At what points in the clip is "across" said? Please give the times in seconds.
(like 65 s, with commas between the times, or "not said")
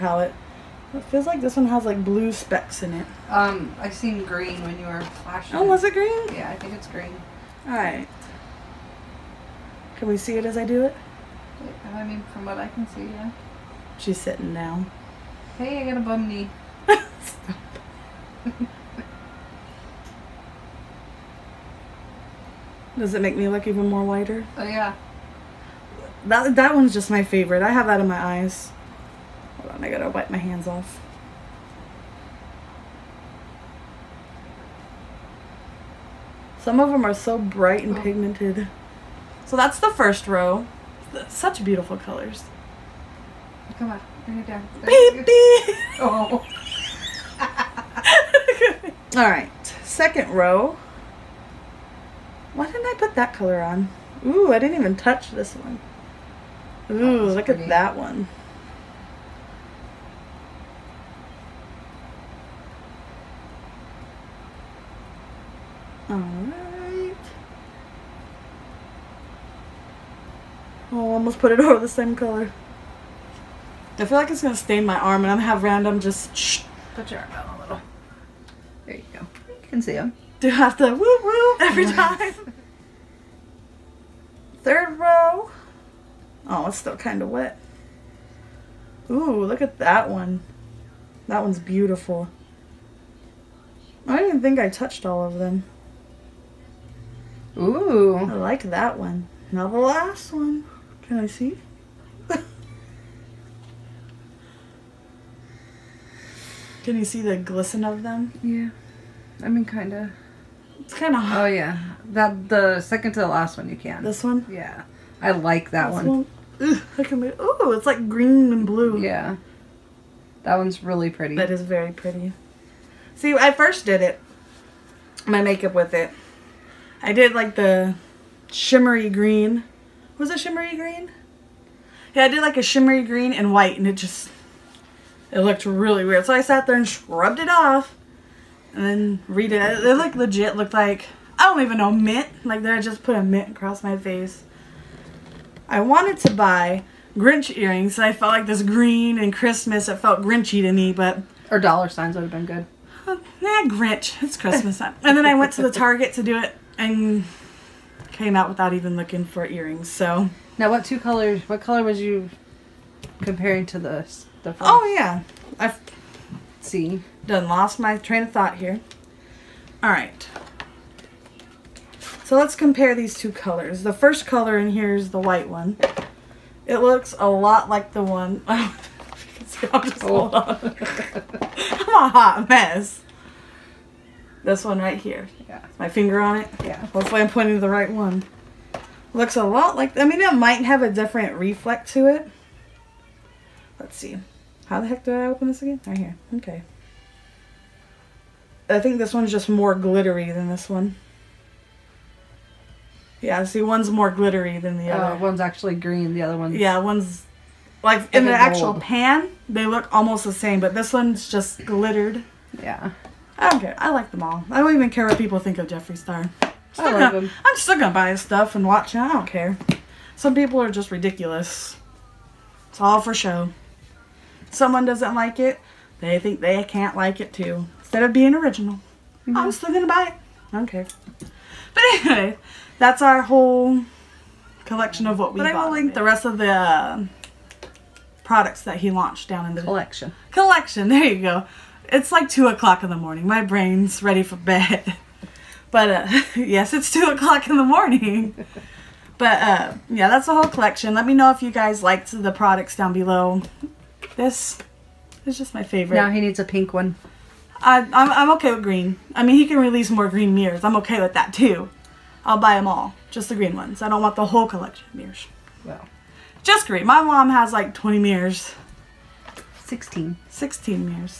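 143 s.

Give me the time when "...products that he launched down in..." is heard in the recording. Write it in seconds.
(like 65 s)
238 s.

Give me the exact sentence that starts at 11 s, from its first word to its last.
I mean, from what I can see, yeah.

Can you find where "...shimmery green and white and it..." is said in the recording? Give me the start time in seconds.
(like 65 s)
132 s.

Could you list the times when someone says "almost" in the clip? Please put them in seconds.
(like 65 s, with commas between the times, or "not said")
71 s, 209 s.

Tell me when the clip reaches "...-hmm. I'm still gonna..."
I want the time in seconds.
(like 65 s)
229 s.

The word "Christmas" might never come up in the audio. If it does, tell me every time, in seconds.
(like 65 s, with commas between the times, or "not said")
149 s, 154 s.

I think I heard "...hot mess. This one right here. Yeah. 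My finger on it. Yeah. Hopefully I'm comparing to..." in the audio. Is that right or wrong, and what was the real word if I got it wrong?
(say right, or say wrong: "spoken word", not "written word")
wrong: "pointing", not "comparing".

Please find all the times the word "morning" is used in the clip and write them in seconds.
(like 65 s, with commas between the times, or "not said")
242 s, 247 s.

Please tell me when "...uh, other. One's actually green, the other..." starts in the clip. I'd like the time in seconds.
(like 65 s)
204 s.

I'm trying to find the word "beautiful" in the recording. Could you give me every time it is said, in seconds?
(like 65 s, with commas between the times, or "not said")
41 s, 91 s.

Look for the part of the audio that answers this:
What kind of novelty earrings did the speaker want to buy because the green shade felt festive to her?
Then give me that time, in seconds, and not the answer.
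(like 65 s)
147 s.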